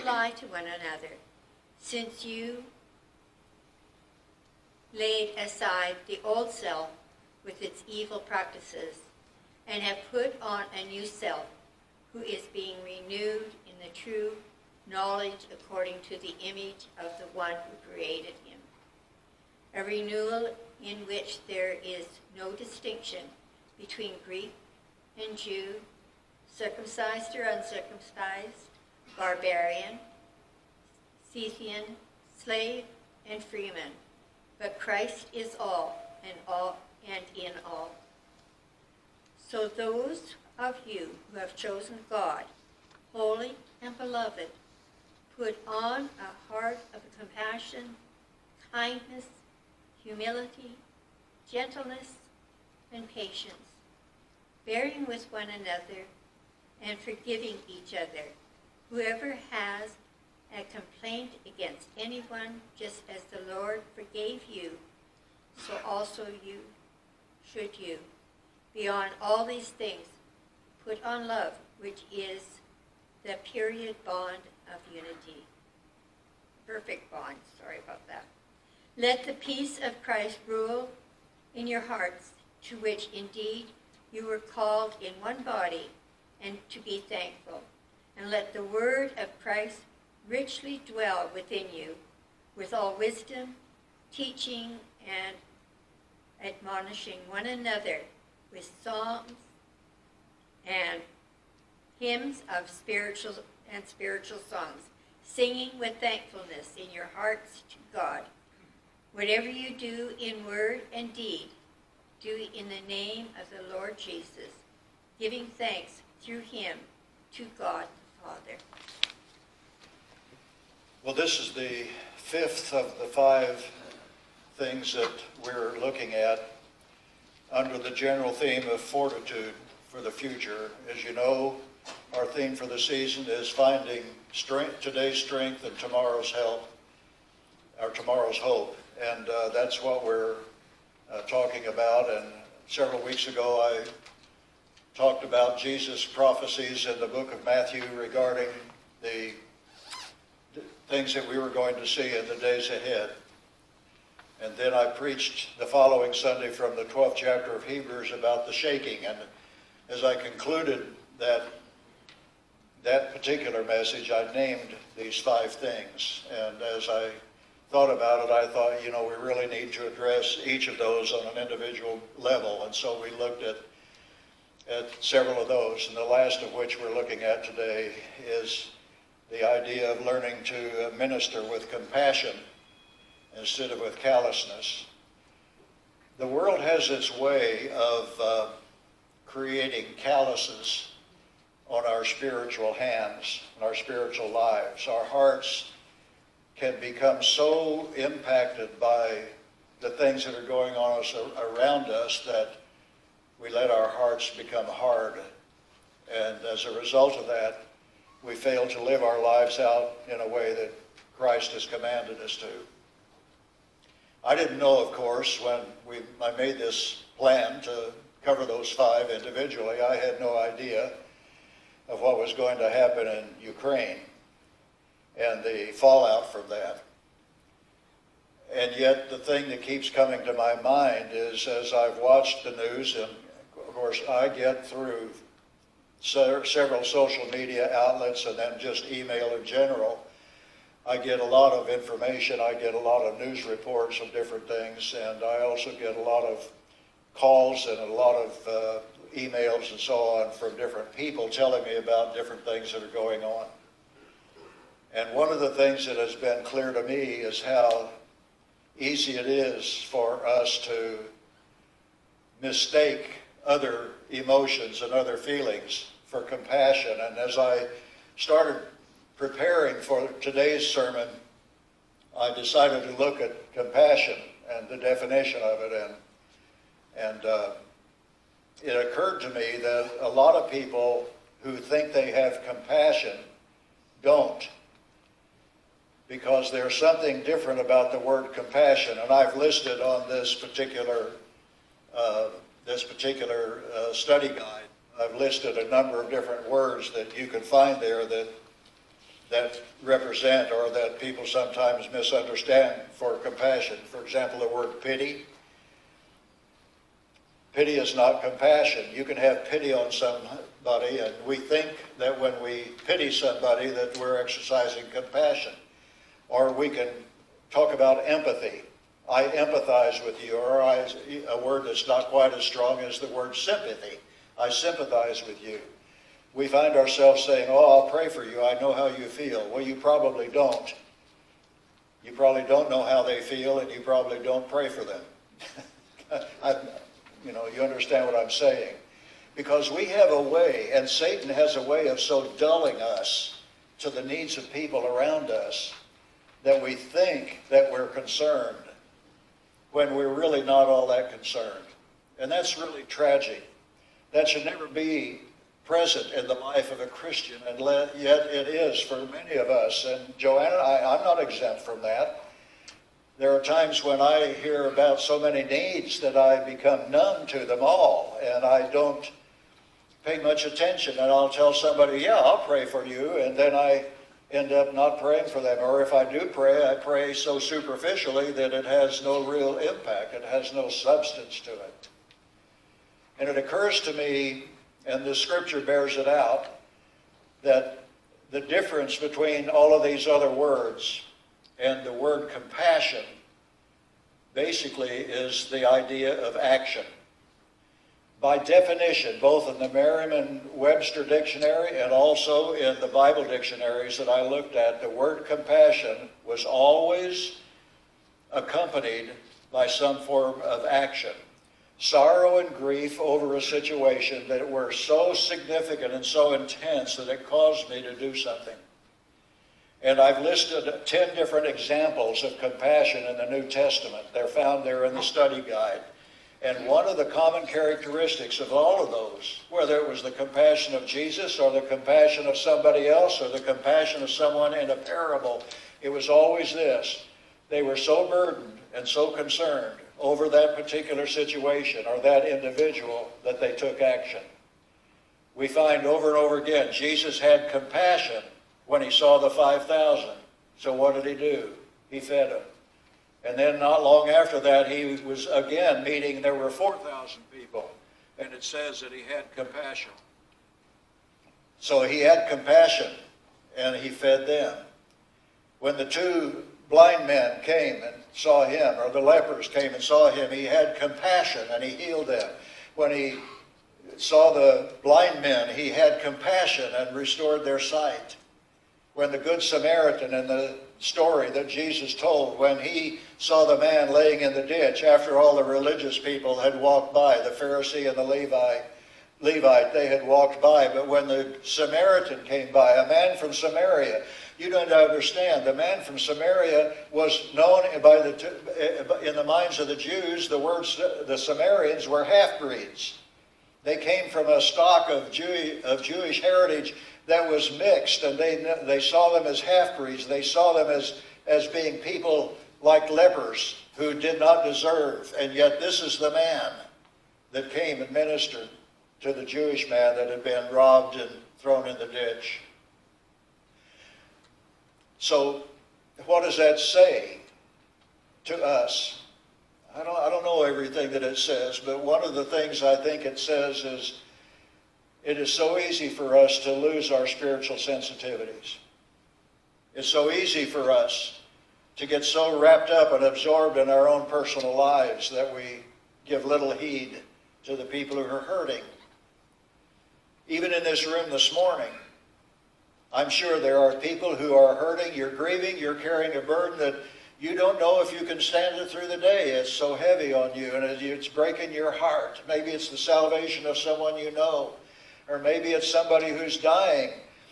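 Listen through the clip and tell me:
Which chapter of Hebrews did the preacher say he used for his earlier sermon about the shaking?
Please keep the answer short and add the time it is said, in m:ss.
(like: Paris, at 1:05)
12th, at 2:36.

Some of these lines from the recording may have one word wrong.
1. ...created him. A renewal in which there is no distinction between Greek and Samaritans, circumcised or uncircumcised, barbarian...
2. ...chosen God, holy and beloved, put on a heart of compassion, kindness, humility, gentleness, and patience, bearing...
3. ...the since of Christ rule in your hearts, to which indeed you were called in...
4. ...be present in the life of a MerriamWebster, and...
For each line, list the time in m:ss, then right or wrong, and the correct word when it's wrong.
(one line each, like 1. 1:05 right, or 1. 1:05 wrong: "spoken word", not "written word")
1. 0:17 wrong: "Jew", not "Samaritans"
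2. 0:41 right
3. 1:19 wrong: "peace", not "since"
4. 5:54 wrong: "Christian", not "MerriamWebster".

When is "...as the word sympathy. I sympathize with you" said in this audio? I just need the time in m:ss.
5:22.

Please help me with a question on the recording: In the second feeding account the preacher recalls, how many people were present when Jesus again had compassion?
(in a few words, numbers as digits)
4,000.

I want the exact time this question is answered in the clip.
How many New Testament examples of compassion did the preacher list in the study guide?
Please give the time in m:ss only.
7:00.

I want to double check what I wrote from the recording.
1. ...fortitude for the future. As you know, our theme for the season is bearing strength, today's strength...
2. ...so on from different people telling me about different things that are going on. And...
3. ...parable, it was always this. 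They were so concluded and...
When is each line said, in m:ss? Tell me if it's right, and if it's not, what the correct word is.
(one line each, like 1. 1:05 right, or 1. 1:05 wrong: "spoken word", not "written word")
1. 2:08 wrong: "finding", not "bearing"
2. 4:09 right
3. 7:14 wrong: "burdened", not "concluded".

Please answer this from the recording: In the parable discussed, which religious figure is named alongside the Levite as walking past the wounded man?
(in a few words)
Pharisee.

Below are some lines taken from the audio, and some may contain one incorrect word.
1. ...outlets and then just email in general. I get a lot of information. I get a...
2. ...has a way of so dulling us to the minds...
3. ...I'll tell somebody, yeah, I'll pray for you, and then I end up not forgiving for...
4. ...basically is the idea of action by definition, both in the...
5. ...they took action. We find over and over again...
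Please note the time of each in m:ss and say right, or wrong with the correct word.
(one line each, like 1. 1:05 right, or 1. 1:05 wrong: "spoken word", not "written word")
1. 3:57 right
2. 5:41 wrong: "needs", not "minds"
3. 6:11 wrong: "praying", not "forgiving"
4. 6:34 right
5. 7:23 right.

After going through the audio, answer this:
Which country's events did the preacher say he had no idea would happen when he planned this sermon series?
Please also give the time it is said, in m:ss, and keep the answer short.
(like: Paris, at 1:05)
Ukraine, at 3:43.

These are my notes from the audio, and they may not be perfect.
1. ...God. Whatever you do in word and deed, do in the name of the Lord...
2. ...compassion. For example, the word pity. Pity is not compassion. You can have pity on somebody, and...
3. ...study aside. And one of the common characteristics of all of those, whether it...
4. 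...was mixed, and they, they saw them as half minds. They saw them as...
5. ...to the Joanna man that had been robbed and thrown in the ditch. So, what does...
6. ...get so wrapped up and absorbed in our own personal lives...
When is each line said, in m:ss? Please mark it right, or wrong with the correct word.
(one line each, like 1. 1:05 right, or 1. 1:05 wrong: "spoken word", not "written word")
1. 1:47 right
2. 5:03 right
3. 7:05 wrong: "guide", not "aside"
4. 8:27 wrong: "breeds", not "minds"
5. 8:39 wrong: "Jewish", not "Joanna"
6. 9:01 right.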